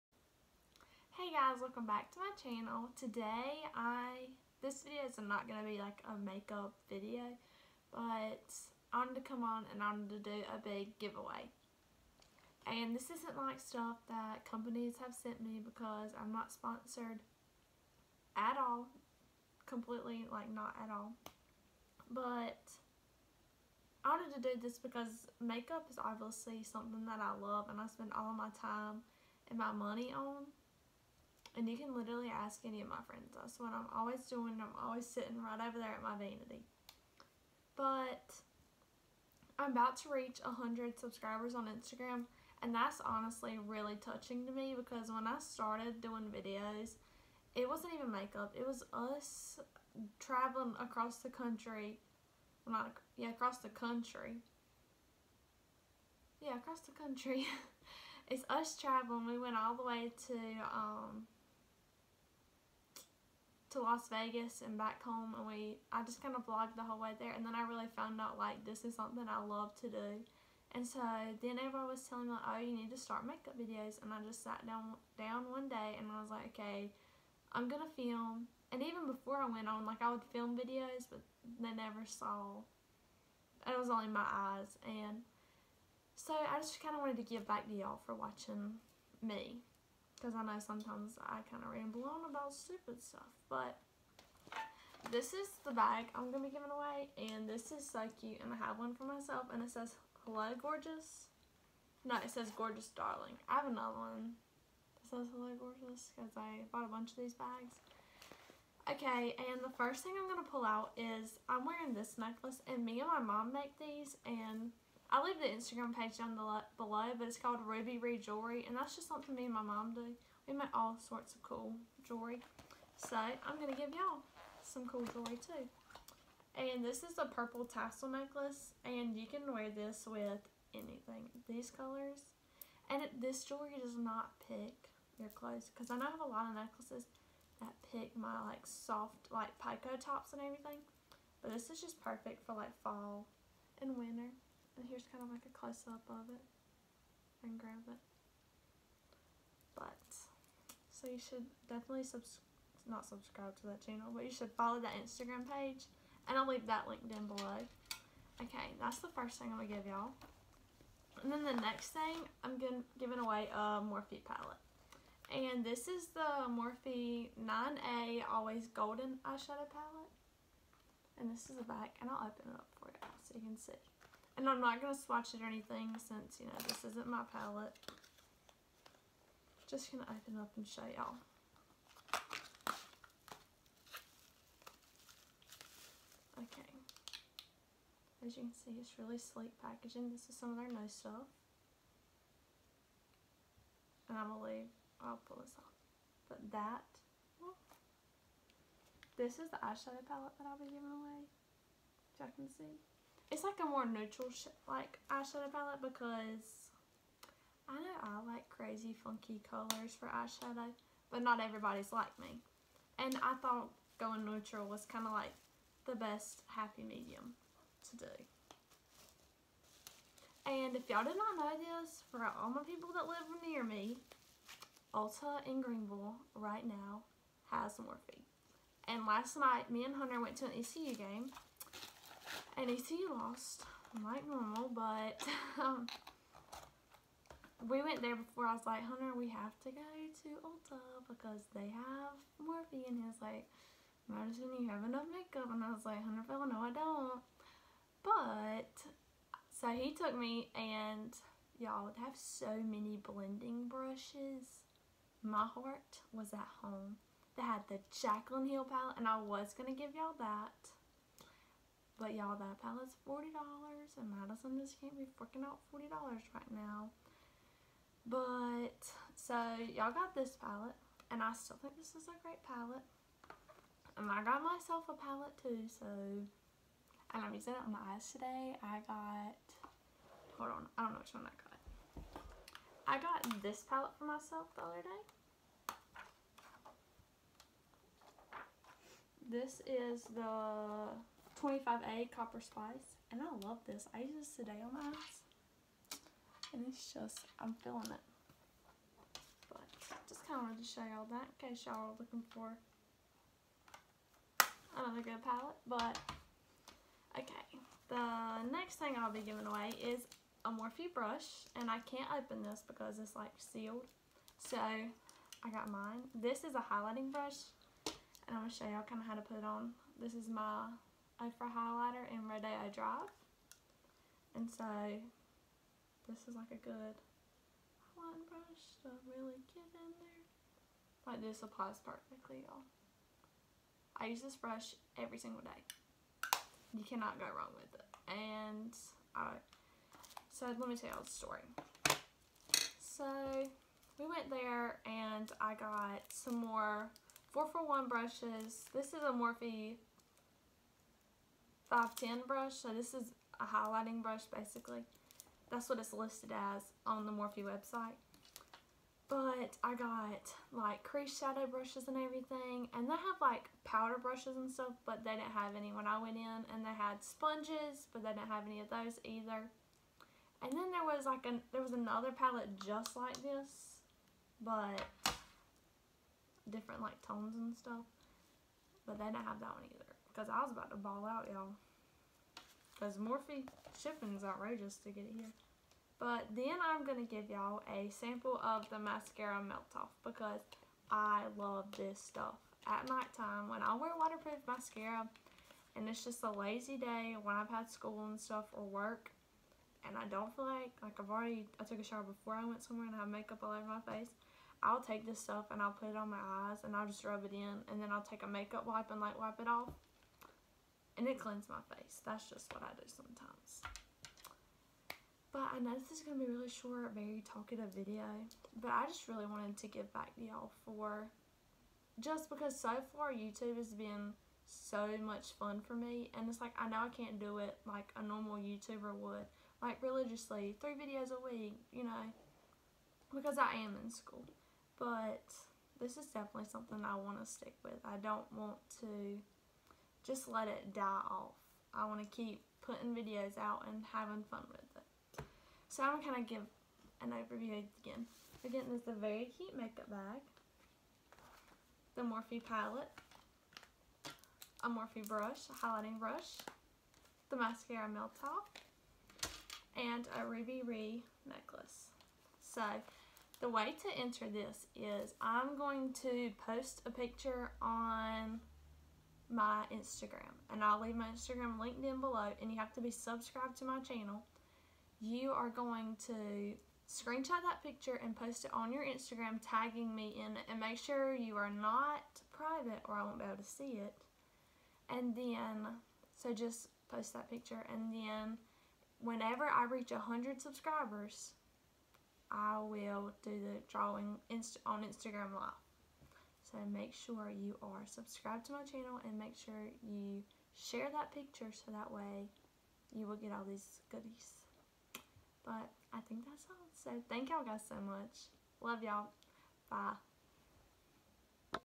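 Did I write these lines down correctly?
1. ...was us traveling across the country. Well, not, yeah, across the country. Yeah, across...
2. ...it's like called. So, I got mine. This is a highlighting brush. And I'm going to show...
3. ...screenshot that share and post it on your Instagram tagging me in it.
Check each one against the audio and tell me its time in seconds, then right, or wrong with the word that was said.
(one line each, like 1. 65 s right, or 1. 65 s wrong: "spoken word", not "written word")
1. 48 s right
2. 312 s wrong: "sealed", not "called"
3. 476 s wrong: "picture", not "share".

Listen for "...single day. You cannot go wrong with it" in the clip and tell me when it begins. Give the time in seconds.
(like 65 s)
335 s.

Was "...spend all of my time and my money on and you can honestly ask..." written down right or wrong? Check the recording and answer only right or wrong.
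wrong.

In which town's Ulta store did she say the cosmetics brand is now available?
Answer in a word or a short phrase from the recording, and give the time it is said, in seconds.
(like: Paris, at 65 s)
Greenville, at 225 s.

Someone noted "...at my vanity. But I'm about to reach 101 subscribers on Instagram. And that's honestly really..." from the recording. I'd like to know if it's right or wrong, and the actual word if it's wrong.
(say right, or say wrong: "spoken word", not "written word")
wrong: "100", not "101".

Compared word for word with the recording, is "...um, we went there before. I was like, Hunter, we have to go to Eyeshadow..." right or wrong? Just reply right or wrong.
wrong.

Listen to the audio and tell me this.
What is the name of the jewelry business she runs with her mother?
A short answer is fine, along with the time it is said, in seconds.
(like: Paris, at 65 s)
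Ruby Rhee Jewelry, at 117 s.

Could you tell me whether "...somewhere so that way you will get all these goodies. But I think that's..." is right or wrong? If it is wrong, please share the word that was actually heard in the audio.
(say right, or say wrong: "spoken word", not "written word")
wrong: "picture", not "somewhere".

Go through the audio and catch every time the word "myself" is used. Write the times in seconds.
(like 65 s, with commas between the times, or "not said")
99 s, 274 s, 284 s.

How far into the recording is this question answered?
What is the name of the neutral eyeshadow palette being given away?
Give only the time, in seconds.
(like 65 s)
168 s.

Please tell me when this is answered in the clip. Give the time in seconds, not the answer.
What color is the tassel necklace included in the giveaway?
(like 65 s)
127 s.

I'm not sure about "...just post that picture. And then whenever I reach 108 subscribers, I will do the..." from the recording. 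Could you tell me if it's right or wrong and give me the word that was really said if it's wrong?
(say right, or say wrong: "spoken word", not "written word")
wrong: "100", not "108".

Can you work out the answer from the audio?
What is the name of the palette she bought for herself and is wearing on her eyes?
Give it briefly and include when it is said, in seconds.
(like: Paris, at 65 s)
Copper Spice, at 292 s.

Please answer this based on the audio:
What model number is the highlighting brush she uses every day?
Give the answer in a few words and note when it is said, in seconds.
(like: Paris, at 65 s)
510, at 351 s.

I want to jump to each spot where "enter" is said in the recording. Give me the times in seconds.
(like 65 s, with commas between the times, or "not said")
464 s.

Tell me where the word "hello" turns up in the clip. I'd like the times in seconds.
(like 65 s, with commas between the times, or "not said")
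100 s, 105 s.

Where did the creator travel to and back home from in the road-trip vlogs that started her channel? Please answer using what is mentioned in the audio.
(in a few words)
Las Vegas.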